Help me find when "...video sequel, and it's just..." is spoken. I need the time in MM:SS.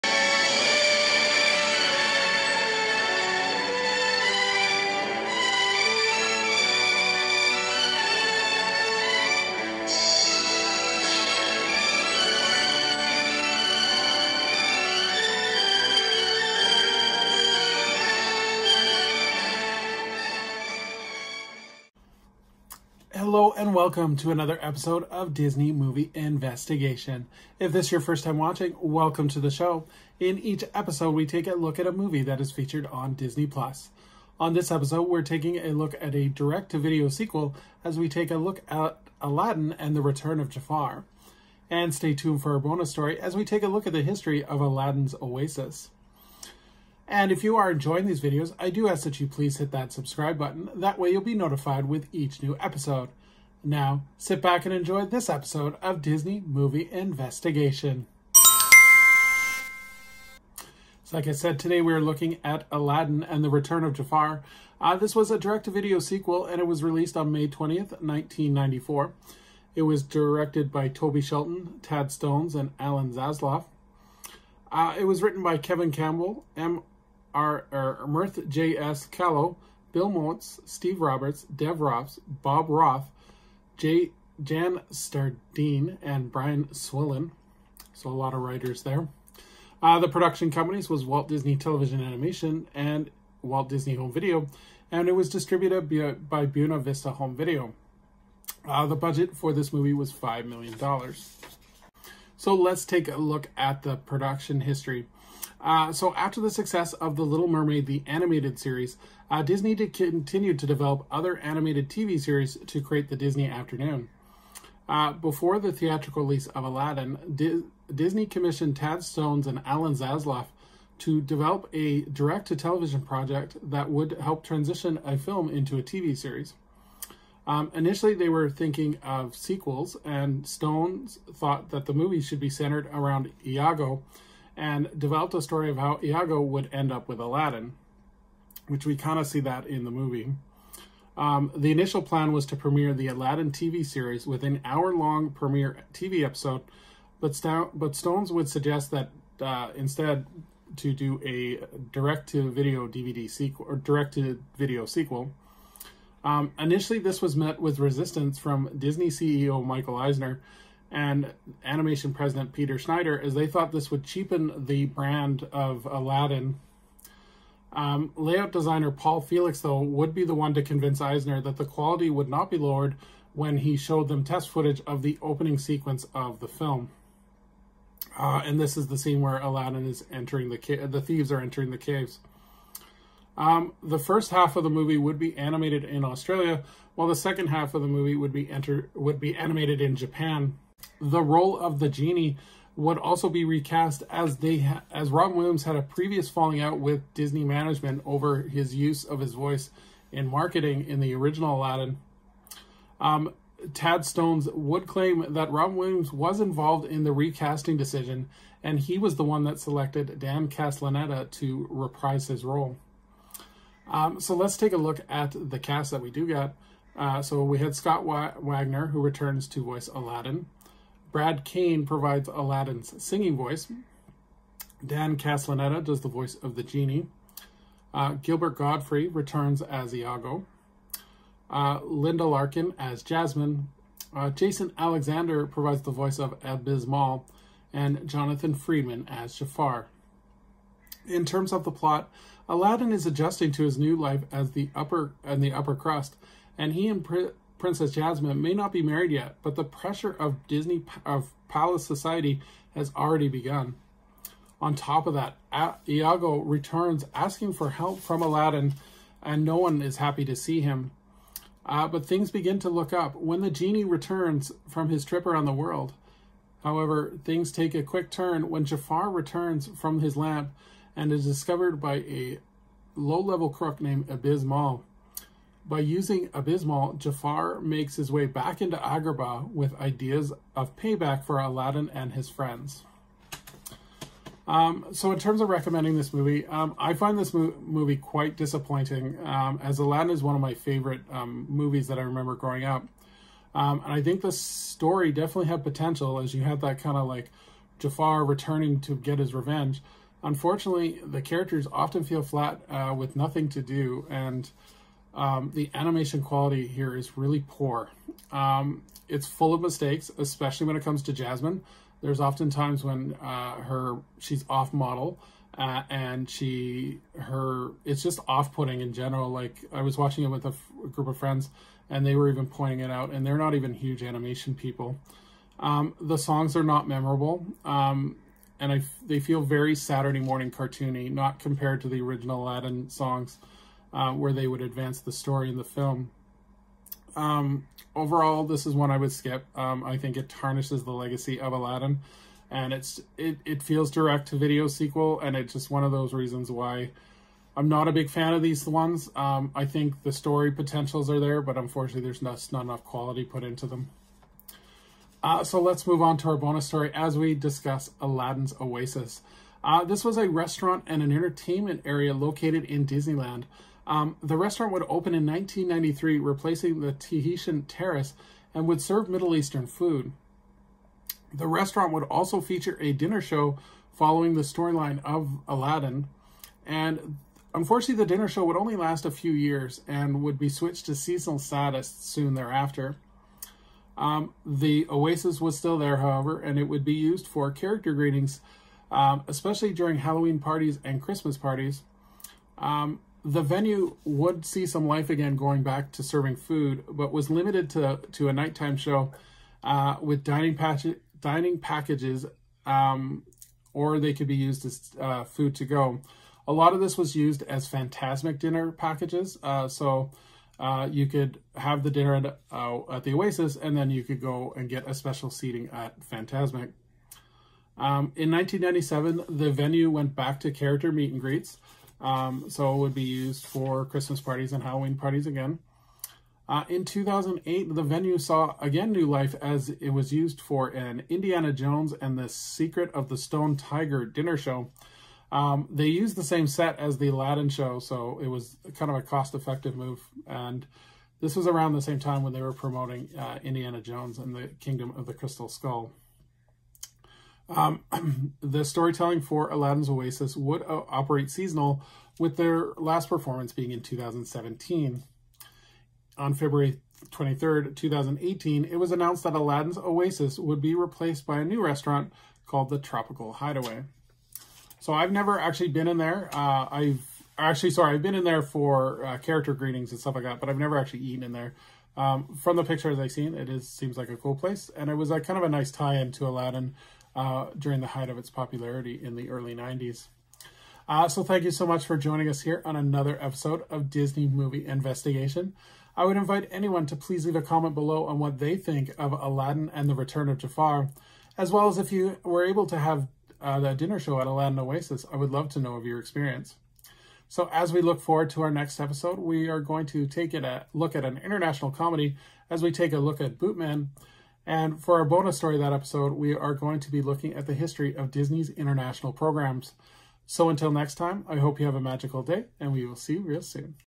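05:44.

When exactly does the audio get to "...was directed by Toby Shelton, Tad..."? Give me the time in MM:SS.
01:09.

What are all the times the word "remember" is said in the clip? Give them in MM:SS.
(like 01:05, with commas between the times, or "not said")
04:52.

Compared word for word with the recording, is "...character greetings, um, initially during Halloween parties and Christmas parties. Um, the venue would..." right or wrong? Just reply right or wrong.
wrong.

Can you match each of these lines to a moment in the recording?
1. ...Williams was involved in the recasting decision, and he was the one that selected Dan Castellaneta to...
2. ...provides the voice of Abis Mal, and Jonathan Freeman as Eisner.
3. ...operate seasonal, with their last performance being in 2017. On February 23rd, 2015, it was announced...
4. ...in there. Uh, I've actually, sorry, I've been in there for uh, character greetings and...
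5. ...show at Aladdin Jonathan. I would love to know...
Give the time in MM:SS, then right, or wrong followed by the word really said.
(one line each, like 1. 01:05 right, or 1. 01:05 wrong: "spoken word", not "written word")
1. 03:25 right
2. 03:55 wrong: "Jafar", not "Eisner"
3. 07:30 wrong: "2018", not "2015"
4. 07:45 right
5. 08:13 wrong: "Oasis", not "Jonathan".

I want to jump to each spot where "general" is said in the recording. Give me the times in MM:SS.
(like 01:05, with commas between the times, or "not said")
05:18.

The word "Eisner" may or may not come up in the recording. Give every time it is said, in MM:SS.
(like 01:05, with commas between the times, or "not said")
02:39, 02:50.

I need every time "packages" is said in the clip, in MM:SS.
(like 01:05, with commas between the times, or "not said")
06:41, 06:48.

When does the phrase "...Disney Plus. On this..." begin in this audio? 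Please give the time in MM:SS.
00:33.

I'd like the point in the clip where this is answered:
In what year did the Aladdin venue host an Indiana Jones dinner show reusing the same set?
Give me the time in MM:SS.
07:06.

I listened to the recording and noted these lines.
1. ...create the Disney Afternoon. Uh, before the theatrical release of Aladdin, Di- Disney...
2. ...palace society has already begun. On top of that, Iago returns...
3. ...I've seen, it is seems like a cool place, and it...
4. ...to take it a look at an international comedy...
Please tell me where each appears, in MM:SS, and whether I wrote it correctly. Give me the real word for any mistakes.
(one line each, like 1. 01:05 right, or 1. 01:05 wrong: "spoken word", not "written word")
1. 01:52 right
2. 04:11 right
3. 07:52 right
4. 08:19 right.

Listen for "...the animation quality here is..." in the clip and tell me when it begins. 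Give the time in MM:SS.
05:05.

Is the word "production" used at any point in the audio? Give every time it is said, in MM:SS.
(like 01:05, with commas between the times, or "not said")
01:30, 01:43.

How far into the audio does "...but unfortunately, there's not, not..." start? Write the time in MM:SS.
05:51.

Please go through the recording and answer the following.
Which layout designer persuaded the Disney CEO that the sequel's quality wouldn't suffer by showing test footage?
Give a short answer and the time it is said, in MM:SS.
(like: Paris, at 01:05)
Paul Felix, at 02:48.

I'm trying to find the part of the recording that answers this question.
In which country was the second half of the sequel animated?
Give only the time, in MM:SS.
03:09.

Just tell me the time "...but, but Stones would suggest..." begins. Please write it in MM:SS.
02:27.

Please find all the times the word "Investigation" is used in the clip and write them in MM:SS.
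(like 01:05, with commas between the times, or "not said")
00:26, 00:56, 08:04.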